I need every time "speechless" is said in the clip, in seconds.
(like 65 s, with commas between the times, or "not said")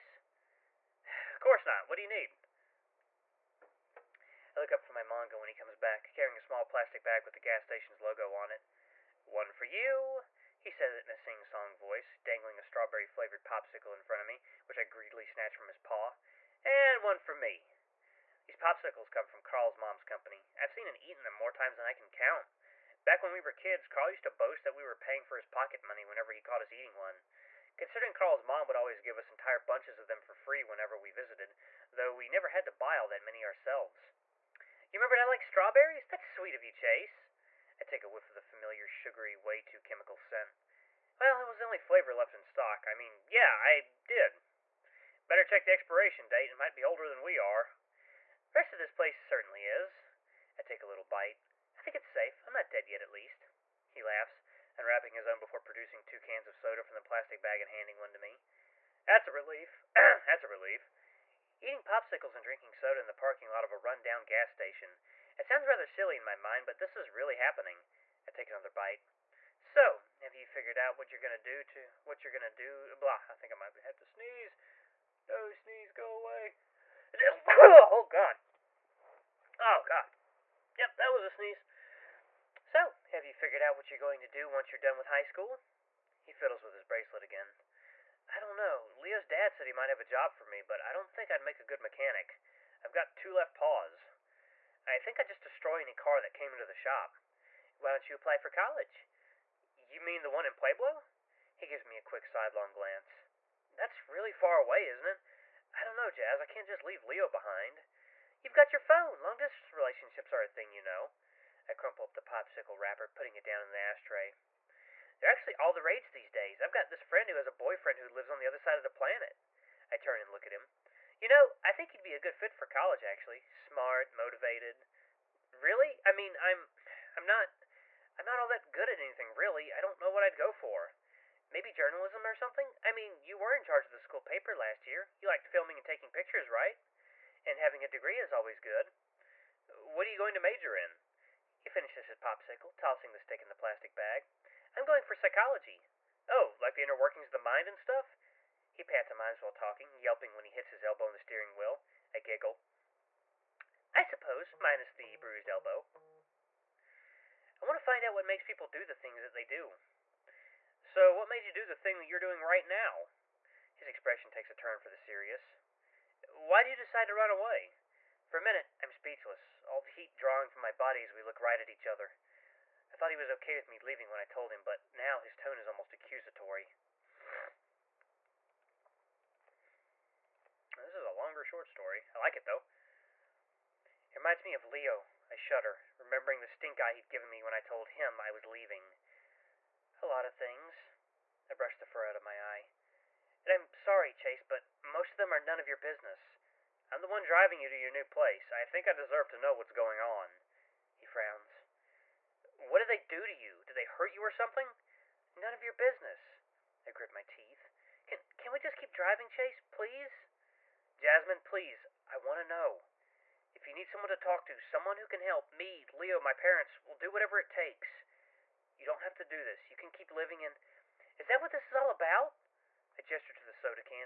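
168 s.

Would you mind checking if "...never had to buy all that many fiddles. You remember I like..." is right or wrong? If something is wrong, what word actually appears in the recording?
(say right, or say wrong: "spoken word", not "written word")
wrong: "ourselves", not "fiddles".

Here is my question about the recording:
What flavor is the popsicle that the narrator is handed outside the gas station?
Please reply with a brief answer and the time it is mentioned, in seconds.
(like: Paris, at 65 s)
Strawberry, at 12 s.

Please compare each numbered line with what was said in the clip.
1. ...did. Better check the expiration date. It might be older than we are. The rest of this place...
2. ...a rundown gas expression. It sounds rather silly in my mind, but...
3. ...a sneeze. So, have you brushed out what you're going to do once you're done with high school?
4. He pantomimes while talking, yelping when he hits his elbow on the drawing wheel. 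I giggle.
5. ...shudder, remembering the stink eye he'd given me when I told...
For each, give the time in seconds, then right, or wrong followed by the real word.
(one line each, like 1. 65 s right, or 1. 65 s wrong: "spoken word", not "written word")
1. 44 s right
2. 63 s wrong: "station", not "expression"
3. 81 s wrong: "figured", not "brushed"
4. 148 s wrong: "steering", not "drawing"
5. 185 s right.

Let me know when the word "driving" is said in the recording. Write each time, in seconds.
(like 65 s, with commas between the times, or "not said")
197 s, 208 s.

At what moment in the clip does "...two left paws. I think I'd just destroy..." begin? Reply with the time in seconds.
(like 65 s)
93 s.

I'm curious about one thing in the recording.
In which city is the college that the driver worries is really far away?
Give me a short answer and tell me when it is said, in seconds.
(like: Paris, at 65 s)
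Pueblo, at 100 s.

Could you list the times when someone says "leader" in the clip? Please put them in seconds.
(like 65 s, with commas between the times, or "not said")
not said.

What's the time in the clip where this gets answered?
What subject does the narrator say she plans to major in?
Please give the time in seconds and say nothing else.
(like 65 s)
145 s.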